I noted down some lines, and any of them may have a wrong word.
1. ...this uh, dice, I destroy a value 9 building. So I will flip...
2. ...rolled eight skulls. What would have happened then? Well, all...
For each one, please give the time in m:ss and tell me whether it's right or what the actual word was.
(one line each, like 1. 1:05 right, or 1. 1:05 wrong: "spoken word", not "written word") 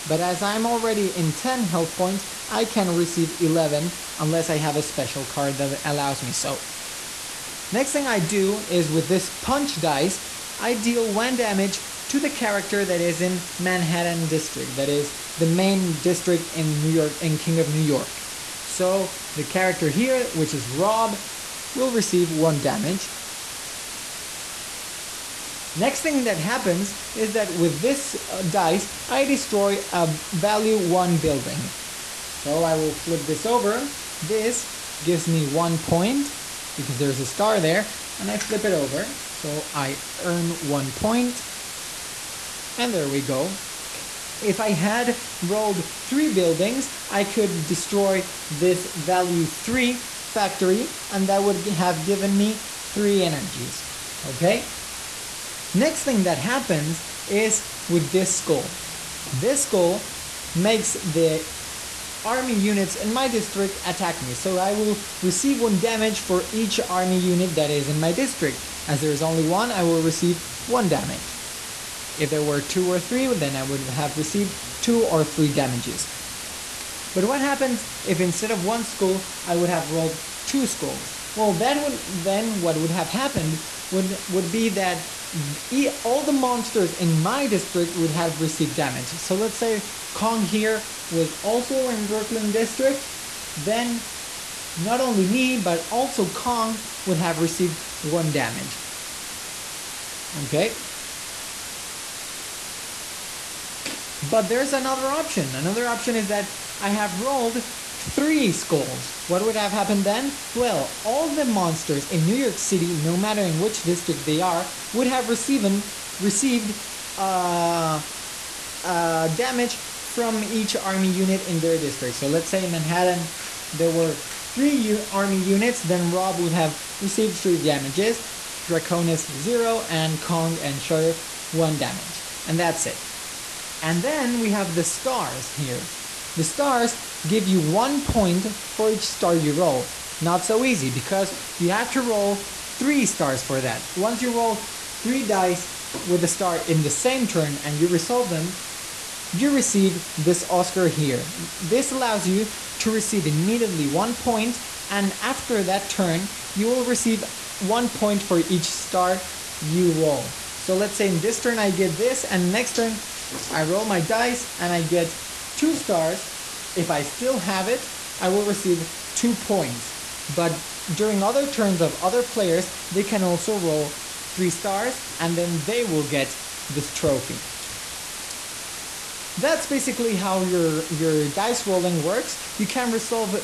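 1. 0:27 wrong: "1", not "9"
2. 1:47 wrong: "three", not "eight".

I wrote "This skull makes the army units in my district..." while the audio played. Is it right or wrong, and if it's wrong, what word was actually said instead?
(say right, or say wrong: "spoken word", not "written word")
right.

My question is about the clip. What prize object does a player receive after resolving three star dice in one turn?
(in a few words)
Oscar.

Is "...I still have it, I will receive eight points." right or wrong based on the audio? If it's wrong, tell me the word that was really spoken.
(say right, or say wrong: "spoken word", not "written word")
wrong: "two", not "eight".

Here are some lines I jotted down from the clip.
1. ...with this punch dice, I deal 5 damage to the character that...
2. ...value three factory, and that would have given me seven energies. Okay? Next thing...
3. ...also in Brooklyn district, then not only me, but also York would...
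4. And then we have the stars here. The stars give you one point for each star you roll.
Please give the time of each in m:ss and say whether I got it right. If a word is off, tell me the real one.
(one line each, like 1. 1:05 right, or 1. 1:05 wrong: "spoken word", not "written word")
1. 0:08 wrong: "1", not "5"
2. 0:48 wrong: "three", not "seven"
3. 1:31 wrong: "Kong", not "York"
4. 2:13 right.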